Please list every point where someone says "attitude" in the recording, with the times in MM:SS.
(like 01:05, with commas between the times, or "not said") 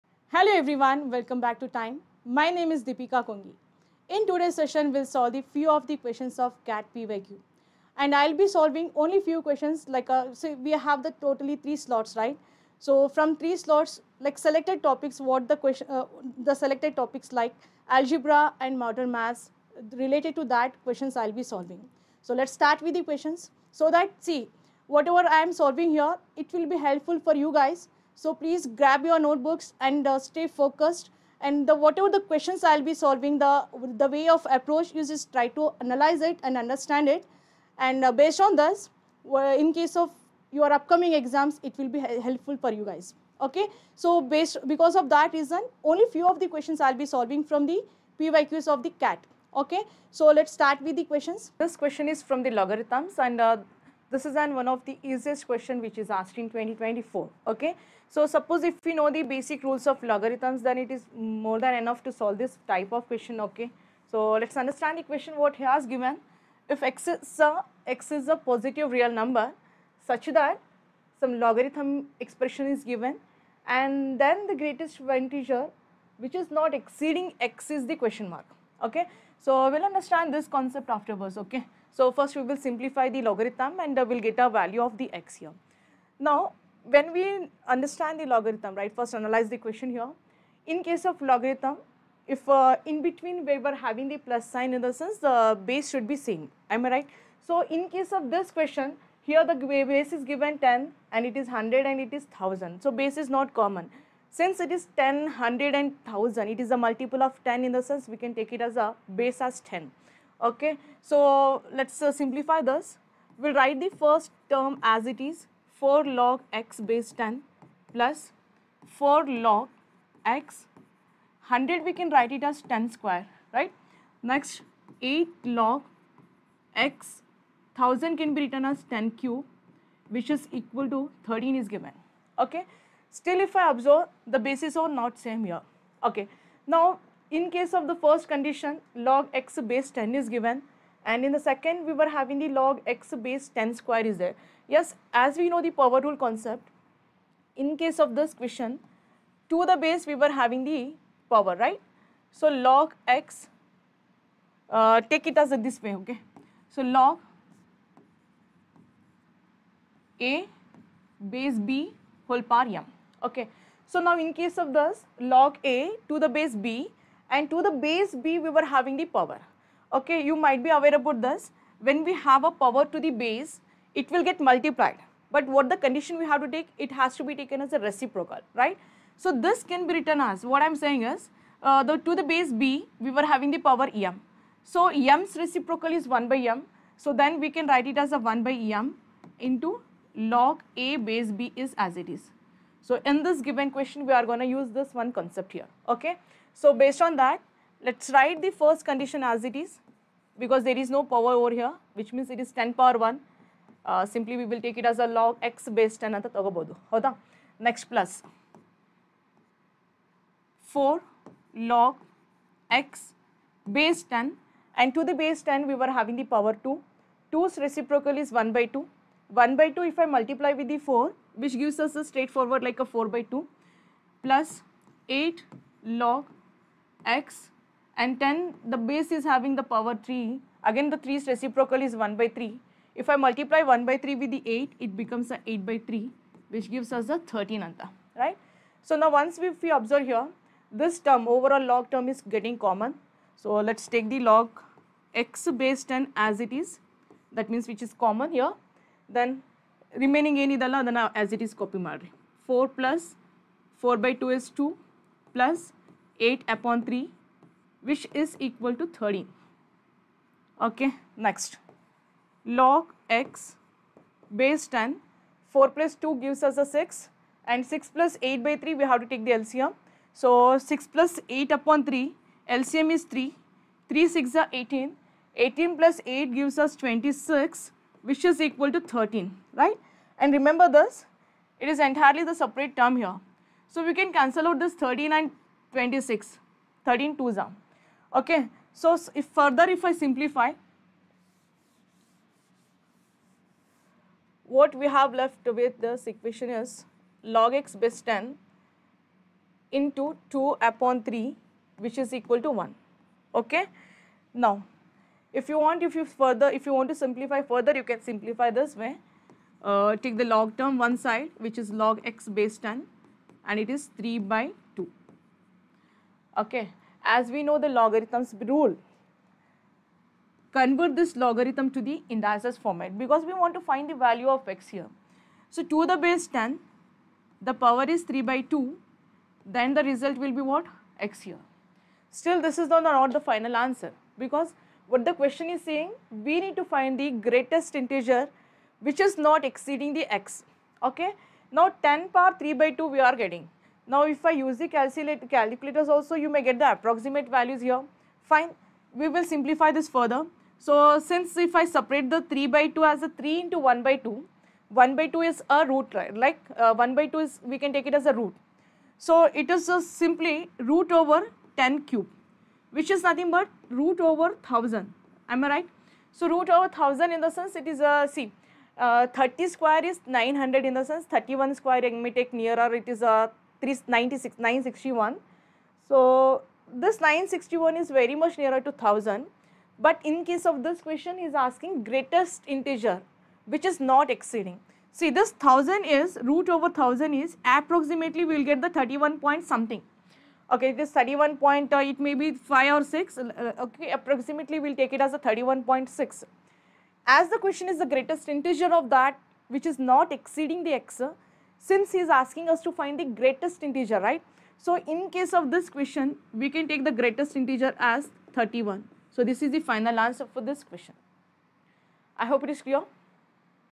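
not said.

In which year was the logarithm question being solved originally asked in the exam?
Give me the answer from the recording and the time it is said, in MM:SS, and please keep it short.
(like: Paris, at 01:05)
2024, at 00:56.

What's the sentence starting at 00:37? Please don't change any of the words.
And uh, based on this, in case of your upcoming exams, it will be helpful for you guys.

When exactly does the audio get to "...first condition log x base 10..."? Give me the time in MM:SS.
02:17.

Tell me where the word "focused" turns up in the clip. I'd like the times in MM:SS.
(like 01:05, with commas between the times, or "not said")
00:30.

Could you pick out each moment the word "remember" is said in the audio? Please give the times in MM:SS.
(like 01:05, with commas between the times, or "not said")
04:40.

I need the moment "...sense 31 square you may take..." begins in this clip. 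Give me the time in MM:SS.
06:10.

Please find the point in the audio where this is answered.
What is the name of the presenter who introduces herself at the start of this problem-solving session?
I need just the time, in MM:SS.
00:02.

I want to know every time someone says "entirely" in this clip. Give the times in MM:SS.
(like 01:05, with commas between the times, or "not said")
04:41.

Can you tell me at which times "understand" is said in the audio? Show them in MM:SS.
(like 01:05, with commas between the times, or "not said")
00:36, 01:04, 01:19, 01:27.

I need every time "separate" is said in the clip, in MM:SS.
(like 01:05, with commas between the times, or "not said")
04:42, 05:51.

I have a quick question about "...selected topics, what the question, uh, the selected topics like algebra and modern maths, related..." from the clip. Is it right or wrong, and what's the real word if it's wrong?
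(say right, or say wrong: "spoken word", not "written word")
right.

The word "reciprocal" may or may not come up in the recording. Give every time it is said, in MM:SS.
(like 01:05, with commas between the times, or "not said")
02:57, 03:05, 03:37, 03:51.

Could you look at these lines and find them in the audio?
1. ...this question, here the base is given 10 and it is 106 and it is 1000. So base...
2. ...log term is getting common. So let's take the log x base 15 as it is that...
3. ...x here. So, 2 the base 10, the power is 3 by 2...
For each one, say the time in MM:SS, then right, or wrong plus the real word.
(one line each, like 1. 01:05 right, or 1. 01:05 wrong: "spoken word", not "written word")
1. 01:38 wrong: "100", not "106"
2. 04:01 wrong: "10", not "15"
3. 05:24 right.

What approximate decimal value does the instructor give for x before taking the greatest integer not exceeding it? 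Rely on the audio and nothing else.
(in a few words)
31.6.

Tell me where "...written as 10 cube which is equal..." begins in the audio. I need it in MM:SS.
02:08.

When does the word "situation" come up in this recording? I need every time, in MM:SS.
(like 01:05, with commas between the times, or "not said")
not said.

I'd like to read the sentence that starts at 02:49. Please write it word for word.
Okay, you might be aware about this.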